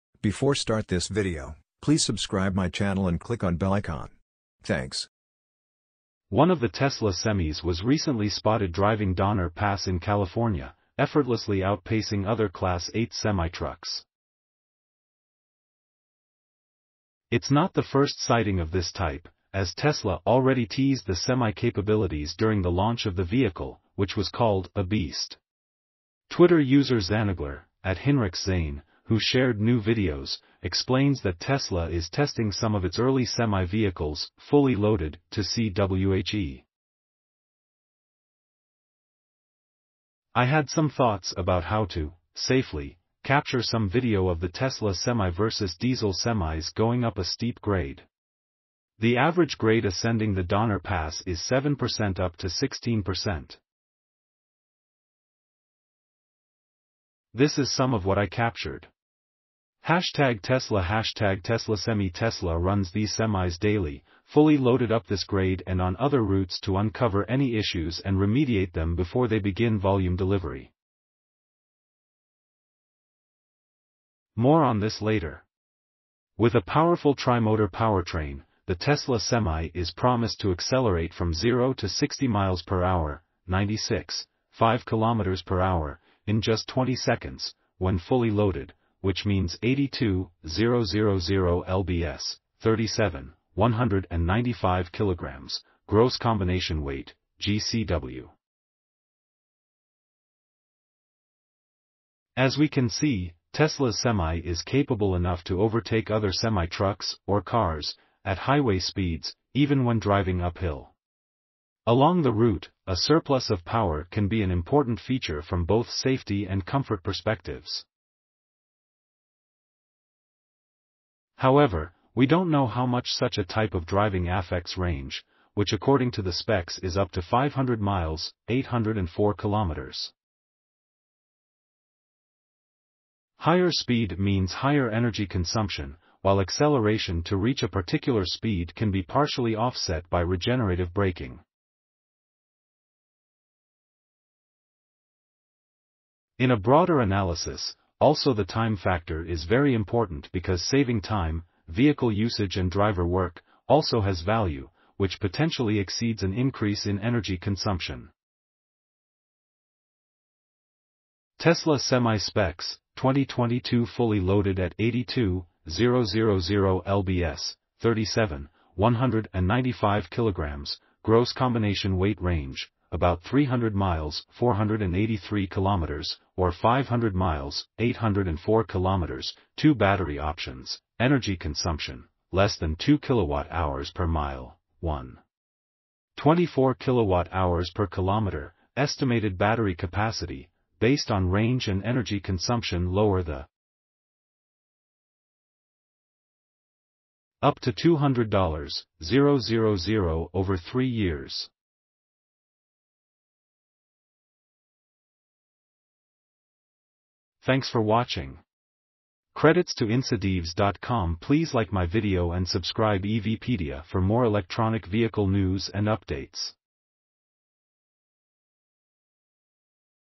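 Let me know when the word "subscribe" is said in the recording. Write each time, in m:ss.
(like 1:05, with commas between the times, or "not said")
0:02, 3:32.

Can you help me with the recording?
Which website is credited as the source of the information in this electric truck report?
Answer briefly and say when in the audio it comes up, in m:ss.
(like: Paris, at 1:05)
InsideEVs.com, at 3:29.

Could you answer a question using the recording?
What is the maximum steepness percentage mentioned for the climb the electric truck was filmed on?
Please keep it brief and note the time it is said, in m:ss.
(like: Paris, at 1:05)
16%, at 0:52.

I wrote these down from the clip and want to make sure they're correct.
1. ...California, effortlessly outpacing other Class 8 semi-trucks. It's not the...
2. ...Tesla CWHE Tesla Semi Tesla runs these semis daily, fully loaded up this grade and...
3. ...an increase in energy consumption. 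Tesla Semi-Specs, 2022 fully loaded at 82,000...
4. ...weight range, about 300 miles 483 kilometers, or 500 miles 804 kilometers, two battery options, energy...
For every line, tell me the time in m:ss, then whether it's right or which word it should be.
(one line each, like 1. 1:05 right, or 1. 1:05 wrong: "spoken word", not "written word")
1. 0:09 right
2. 1:00 wrong: "Hashtag", not "CWHE"
3. 2:36 right
4. 2:51 right.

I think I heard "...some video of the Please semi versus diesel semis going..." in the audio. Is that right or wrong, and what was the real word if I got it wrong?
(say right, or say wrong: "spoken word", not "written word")
wrong: "Tesla", not "Please".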